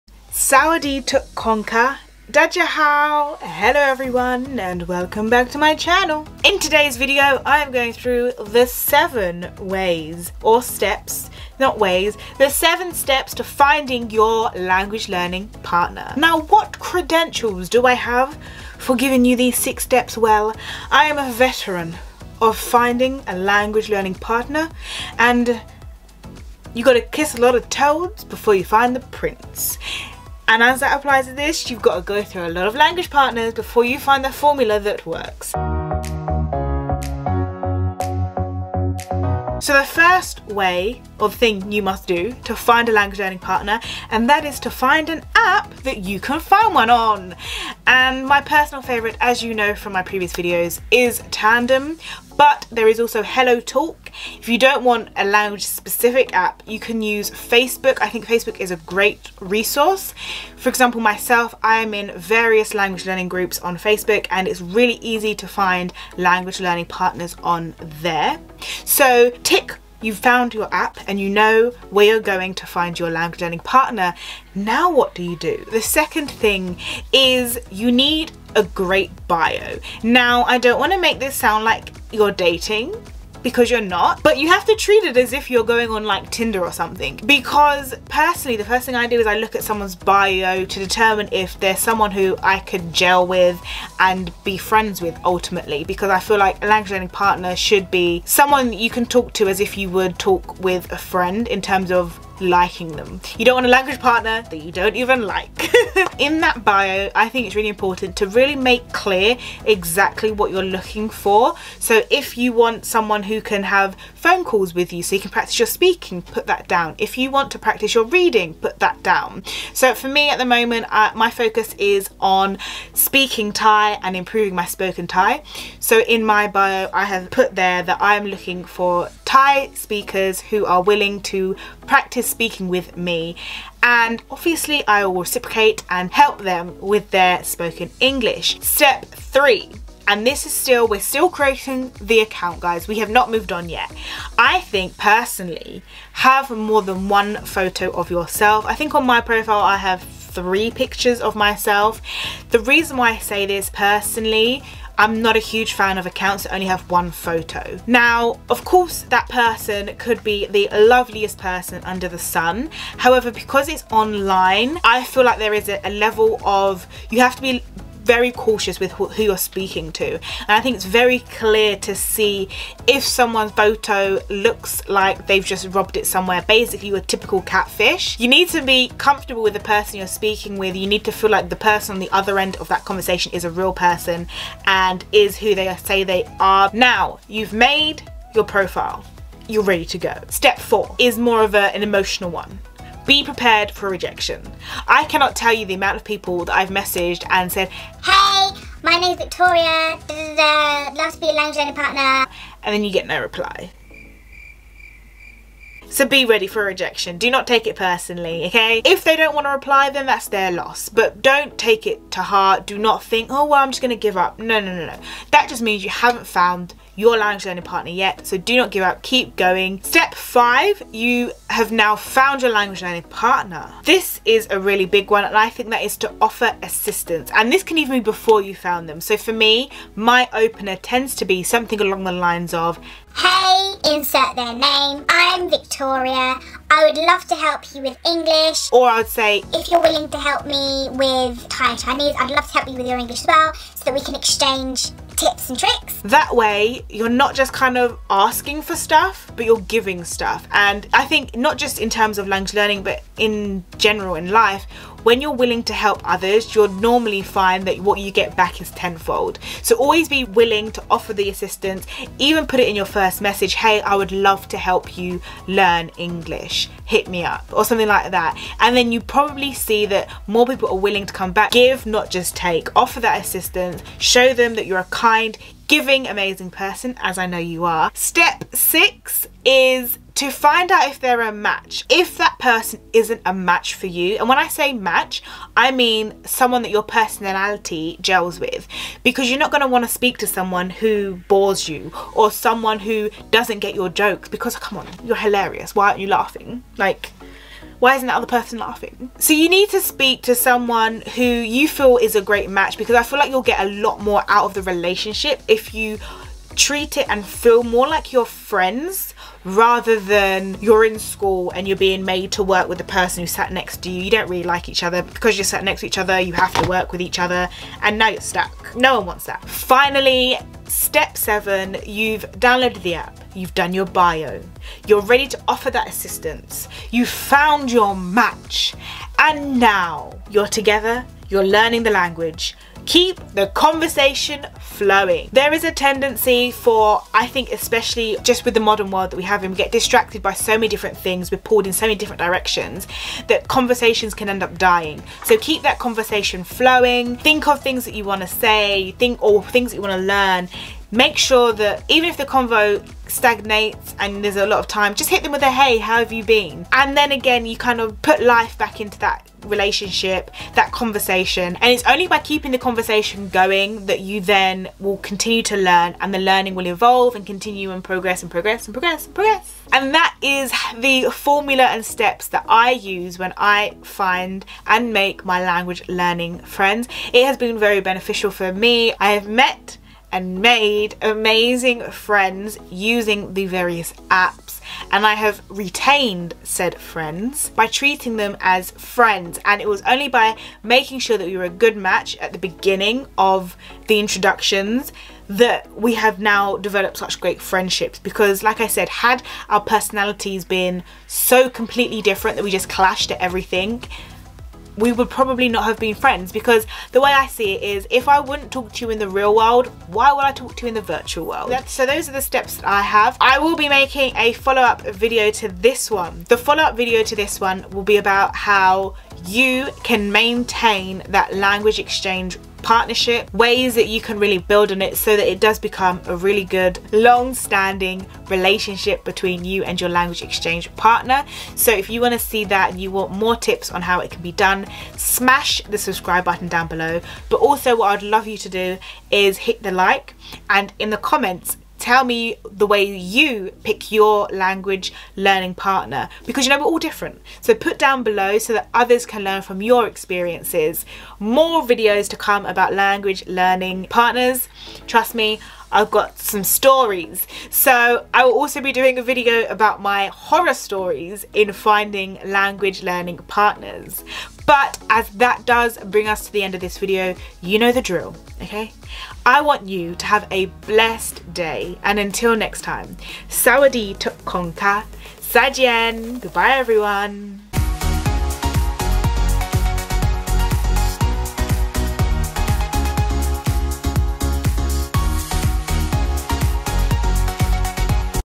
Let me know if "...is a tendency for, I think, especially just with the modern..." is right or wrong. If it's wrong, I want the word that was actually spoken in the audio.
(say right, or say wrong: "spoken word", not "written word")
right.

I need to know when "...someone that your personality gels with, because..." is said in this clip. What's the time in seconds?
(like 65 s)
286 s.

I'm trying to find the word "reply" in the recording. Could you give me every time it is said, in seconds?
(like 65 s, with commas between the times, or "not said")
203 s, 209 s.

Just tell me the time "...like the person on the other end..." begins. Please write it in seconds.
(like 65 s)
181 s.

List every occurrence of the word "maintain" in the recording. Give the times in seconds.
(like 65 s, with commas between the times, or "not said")
420 s.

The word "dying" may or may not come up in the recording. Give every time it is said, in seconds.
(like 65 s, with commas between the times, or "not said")
344 s.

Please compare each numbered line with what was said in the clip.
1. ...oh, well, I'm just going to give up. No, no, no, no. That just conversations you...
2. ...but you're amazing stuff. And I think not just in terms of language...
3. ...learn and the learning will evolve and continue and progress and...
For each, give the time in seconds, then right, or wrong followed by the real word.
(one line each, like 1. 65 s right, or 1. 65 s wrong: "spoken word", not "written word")
1. 213 s wrong: "means", not "conversations"
2. 249 s wrong: "giving", not "amazing"
3. 365 s right.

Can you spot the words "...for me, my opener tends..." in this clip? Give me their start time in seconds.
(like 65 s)
229 s.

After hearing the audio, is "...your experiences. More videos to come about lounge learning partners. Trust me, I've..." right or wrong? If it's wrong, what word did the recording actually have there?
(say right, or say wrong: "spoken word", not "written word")
wrong: "language", not "lounge".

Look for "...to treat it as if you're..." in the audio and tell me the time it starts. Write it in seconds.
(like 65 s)
84 s.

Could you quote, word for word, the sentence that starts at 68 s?
So tick You've found your app and you know where you're going to find your language learning partner.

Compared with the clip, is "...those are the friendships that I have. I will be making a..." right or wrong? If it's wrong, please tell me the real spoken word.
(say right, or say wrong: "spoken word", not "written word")
wrong: "steps", not "friendships".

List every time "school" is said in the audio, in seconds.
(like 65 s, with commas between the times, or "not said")
310 s.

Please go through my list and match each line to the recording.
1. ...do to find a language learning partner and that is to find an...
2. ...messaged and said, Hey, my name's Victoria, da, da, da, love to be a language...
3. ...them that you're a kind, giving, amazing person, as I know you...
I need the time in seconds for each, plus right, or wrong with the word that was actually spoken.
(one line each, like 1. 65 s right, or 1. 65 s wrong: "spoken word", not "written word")
1. 42 s right
2. 196 s right
3. 274 s right.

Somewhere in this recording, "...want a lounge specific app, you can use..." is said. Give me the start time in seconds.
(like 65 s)
54 s.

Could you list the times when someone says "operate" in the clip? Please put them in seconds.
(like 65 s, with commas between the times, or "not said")
not said.